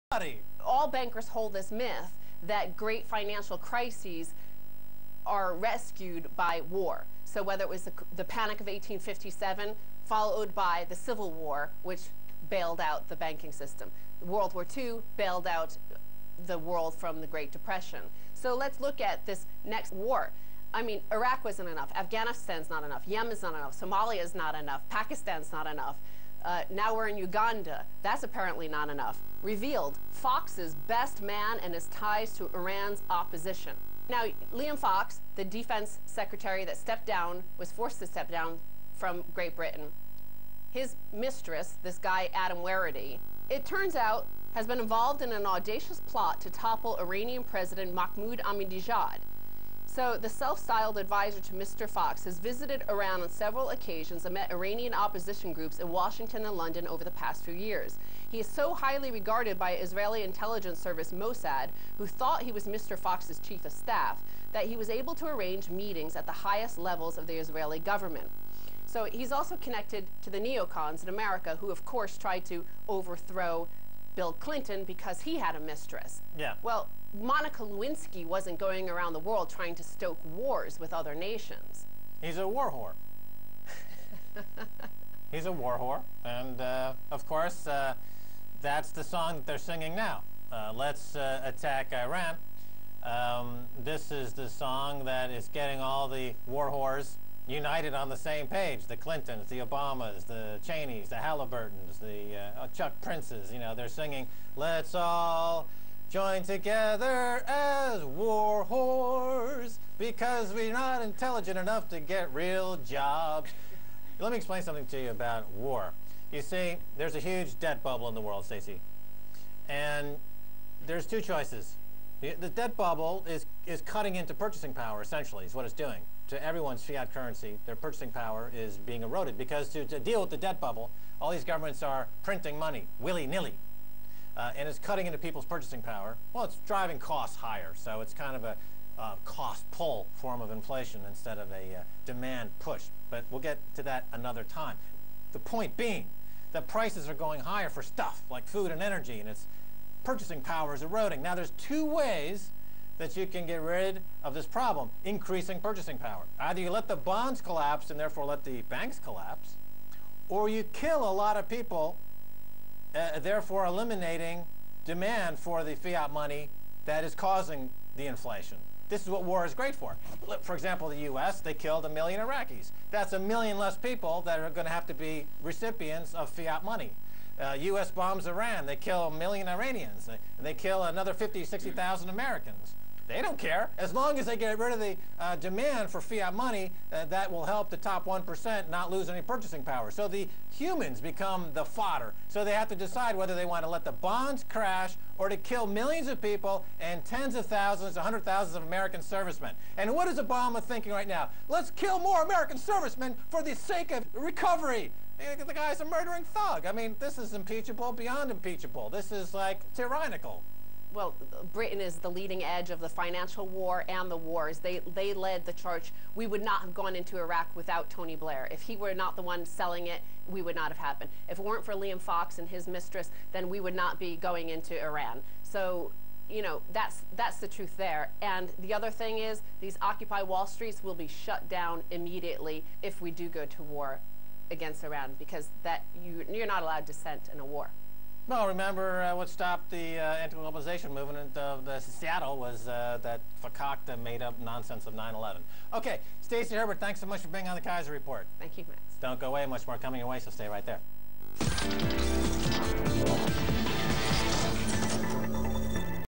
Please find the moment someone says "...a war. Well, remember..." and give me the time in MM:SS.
03:57.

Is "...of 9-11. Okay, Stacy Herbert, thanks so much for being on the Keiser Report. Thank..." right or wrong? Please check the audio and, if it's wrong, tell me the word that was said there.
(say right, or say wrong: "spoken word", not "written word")
right.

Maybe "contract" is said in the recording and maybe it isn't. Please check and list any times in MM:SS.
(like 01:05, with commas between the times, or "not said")
not said.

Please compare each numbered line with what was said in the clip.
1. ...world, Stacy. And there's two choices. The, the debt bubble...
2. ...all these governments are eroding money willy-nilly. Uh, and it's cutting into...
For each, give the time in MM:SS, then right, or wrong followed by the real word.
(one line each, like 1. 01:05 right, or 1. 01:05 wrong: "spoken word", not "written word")
1. 01:58 right
2. 02:11 wrong: "printing", not "eroding".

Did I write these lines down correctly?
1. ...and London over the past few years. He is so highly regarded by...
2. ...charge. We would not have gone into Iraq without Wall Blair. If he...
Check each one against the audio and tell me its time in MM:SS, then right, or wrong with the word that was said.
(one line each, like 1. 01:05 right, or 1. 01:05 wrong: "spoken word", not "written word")
1. 00:56 right
2. 03:35 wrong: "Tony", not "Wall".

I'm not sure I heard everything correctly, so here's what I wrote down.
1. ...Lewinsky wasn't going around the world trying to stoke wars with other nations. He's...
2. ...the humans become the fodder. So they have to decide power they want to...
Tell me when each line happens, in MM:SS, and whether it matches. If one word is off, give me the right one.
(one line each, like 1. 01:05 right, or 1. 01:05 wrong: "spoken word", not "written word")
1. 01:17 right
2. 03:10 wrong: "whether", not "power".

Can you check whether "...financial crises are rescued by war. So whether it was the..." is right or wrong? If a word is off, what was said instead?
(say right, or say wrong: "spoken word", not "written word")
right.